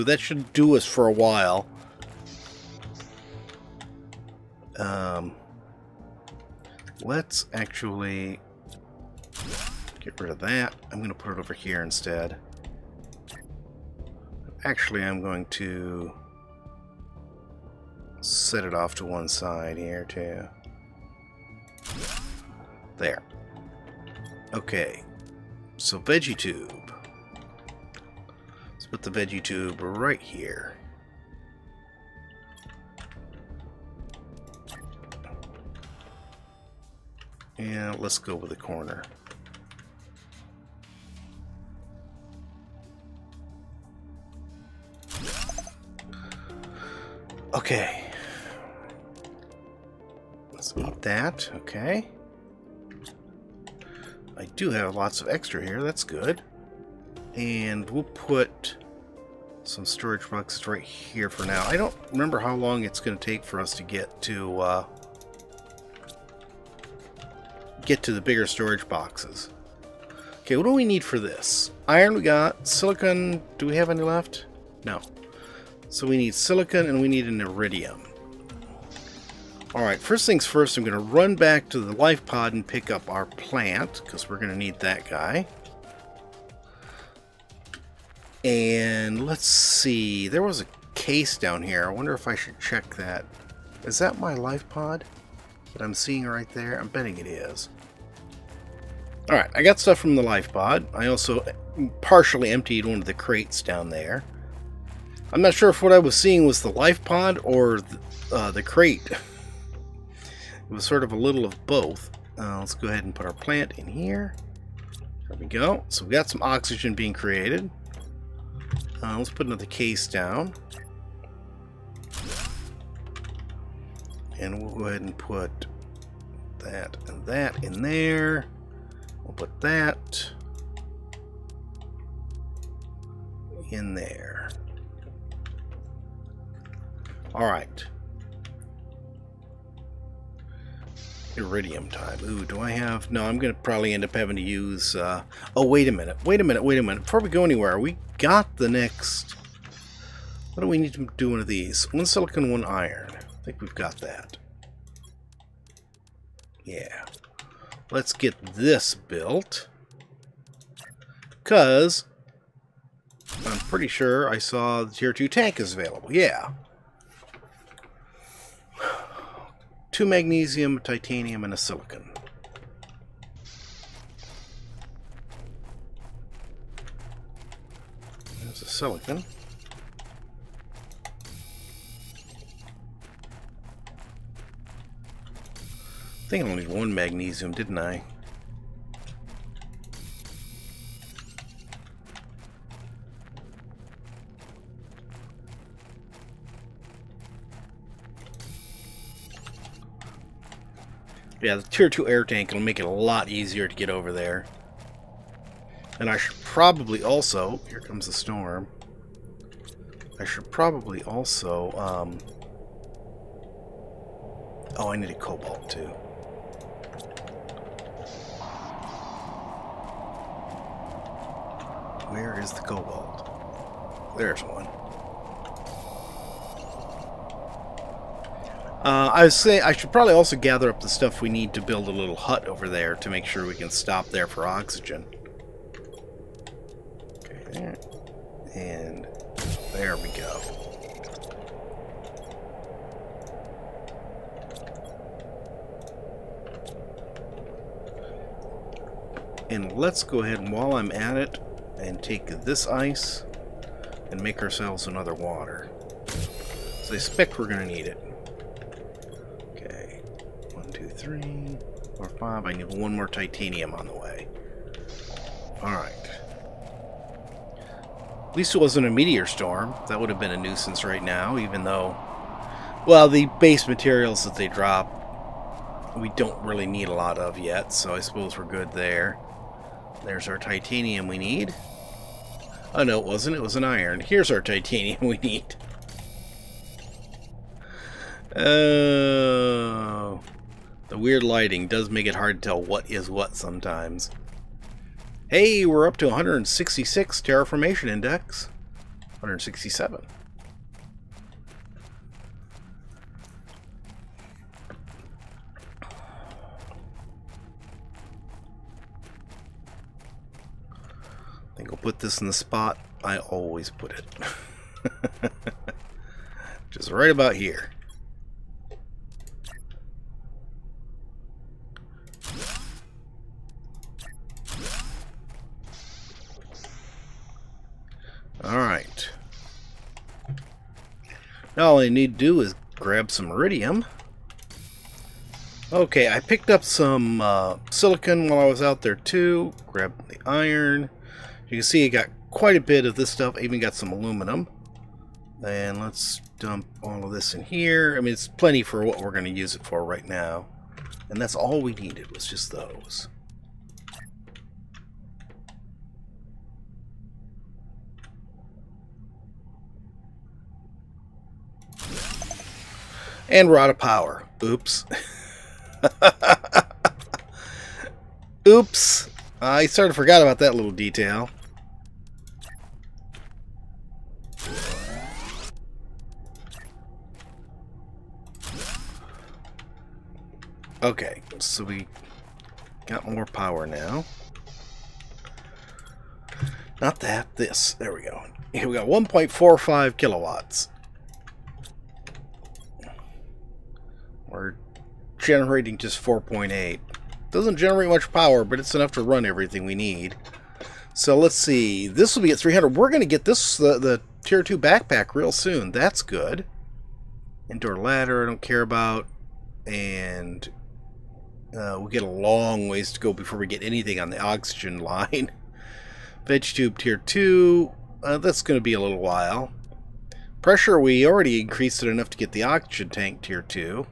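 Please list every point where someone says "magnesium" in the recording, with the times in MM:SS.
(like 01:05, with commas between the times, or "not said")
02:50, 03:06.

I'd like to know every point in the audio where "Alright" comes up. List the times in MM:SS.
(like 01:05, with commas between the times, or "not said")
01:19, 01:39, 04:25.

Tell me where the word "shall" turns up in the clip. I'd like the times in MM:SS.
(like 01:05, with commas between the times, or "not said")
not said.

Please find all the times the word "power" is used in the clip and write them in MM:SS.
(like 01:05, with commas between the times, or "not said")
06:03, 06:23, 06:38.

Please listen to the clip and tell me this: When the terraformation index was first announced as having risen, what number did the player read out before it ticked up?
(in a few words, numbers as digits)
166.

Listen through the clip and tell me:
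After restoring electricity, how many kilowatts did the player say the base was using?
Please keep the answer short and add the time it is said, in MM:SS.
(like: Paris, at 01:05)
1.45 kilowatts, at 06:28.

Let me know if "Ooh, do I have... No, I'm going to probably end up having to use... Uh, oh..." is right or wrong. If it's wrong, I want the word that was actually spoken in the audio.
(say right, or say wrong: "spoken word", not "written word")
right.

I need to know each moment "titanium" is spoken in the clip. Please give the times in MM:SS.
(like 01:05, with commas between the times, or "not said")
02:50, 04:23, 04:40, 04:44.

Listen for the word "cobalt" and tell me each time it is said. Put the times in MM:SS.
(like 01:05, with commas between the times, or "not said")
03:35, 03:42.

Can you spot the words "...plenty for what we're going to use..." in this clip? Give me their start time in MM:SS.
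05:48.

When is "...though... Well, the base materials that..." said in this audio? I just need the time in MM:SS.
04:31.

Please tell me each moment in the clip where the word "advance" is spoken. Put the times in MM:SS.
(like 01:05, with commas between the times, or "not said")
not said.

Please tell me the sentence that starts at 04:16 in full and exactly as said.
So I expect we're going to need it three, four, five.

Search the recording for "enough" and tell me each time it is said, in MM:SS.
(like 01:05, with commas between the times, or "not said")
06:38, 07:01.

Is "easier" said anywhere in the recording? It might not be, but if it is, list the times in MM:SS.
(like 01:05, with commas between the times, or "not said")
03:23.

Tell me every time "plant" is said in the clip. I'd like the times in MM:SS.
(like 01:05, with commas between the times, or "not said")
01:23, 01:53.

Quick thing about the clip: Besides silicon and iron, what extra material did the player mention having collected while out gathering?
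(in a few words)
aluminum.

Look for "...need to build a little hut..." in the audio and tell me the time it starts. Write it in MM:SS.
03:51.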